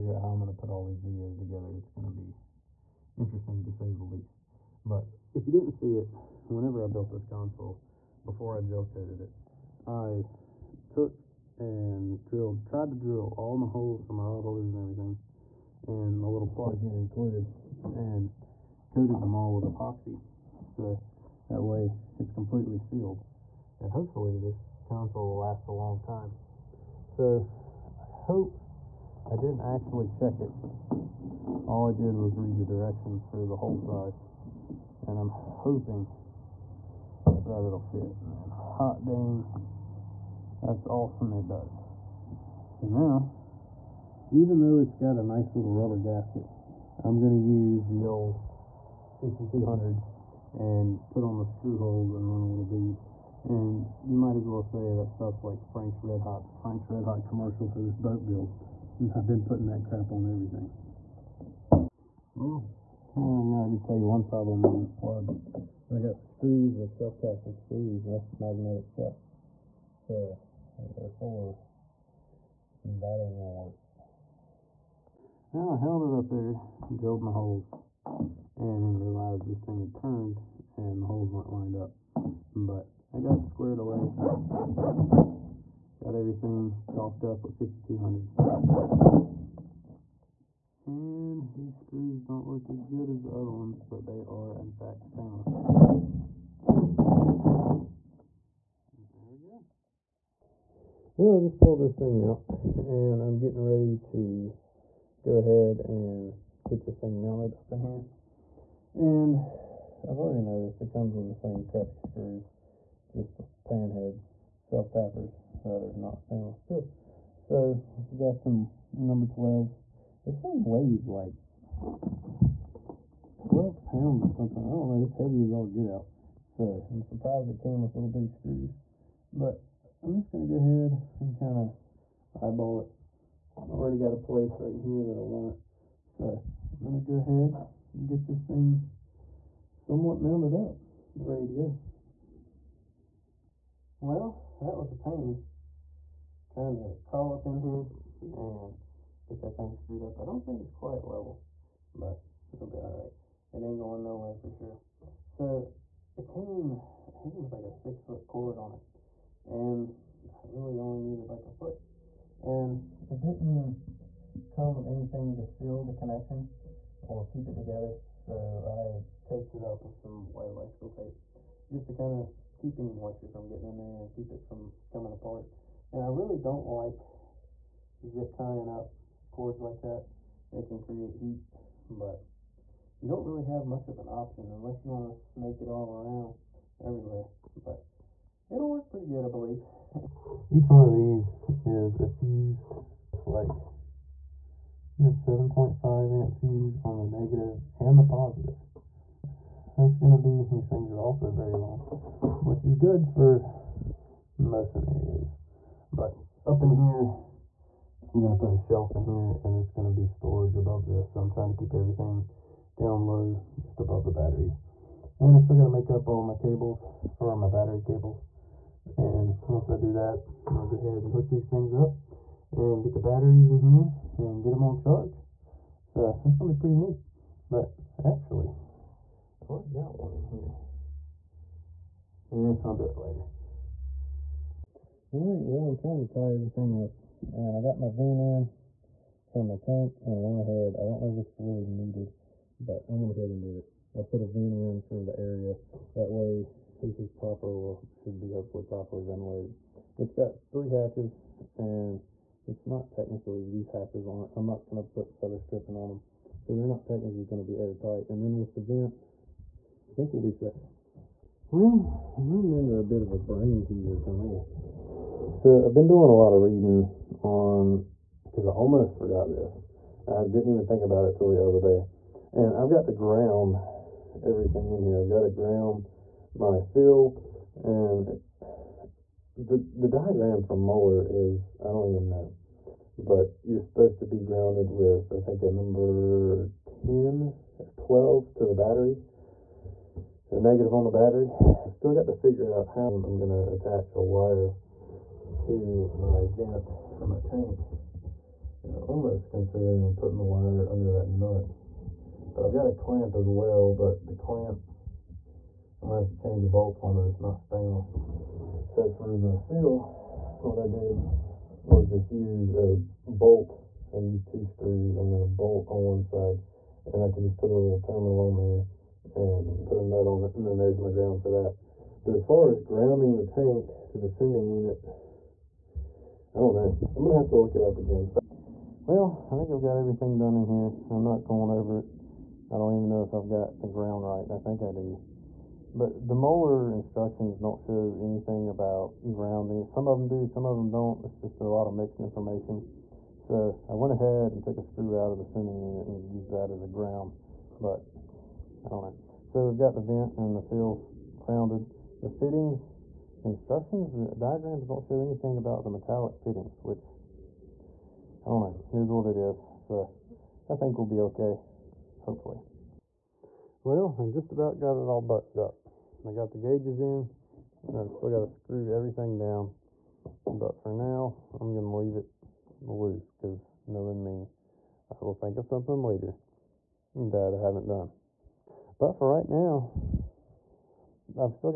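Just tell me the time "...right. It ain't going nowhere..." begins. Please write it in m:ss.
2:32.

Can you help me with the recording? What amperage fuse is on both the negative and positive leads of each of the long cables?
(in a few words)
7.5 amp.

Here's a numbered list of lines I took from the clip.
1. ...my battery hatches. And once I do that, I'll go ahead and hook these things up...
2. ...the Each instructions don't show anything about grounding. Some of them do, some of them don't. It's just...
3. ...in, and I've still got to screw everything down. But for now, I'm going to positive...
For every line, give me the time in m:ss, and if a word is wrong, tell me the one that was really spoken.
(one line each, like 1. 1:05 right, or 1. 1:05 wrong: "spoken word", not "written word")
1. 3:37 wrong: "cables", not "hatches"
2. 5:36 wrong: "Moeller", not "Each"
3. 6:06 wrong: "leave", not "positive".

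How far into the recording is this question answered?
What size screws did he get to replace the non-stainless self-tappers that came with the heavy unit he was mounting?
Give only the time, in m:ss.
1:58.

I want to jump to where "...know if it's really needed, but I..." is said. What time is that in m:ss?
4:01.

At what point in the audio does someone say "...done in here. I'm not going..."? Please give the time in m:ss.
5:30.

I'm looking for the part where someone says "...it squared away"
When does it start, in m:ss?
1:23.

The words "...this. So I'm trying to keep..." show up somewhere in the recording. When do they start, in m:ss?
3:30.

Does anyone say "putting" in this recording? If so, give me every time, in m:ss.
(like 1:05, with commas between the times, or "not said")
0:59, 4:59.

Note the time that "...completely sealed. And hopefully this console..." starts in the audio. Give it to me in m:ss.
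0:22.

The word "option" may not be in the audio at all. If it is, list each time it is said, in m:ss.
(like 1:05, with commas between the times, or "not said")
3:04.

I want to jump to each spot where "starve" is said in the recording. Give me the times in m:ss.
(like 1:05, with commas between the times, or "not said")
not said.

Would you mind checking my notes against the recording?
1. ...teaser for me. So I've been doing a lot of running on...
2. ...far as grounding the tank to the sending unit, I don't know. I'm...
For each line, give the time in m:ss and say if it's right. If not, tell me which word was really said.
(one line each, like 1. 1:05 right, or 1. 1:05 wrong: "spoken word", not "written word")
1. 4:23 wrong: "reading", not "running"
2. 5:22 right.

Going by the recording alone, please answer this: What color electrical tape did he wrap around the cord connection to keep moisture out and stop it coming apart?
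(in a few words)
white.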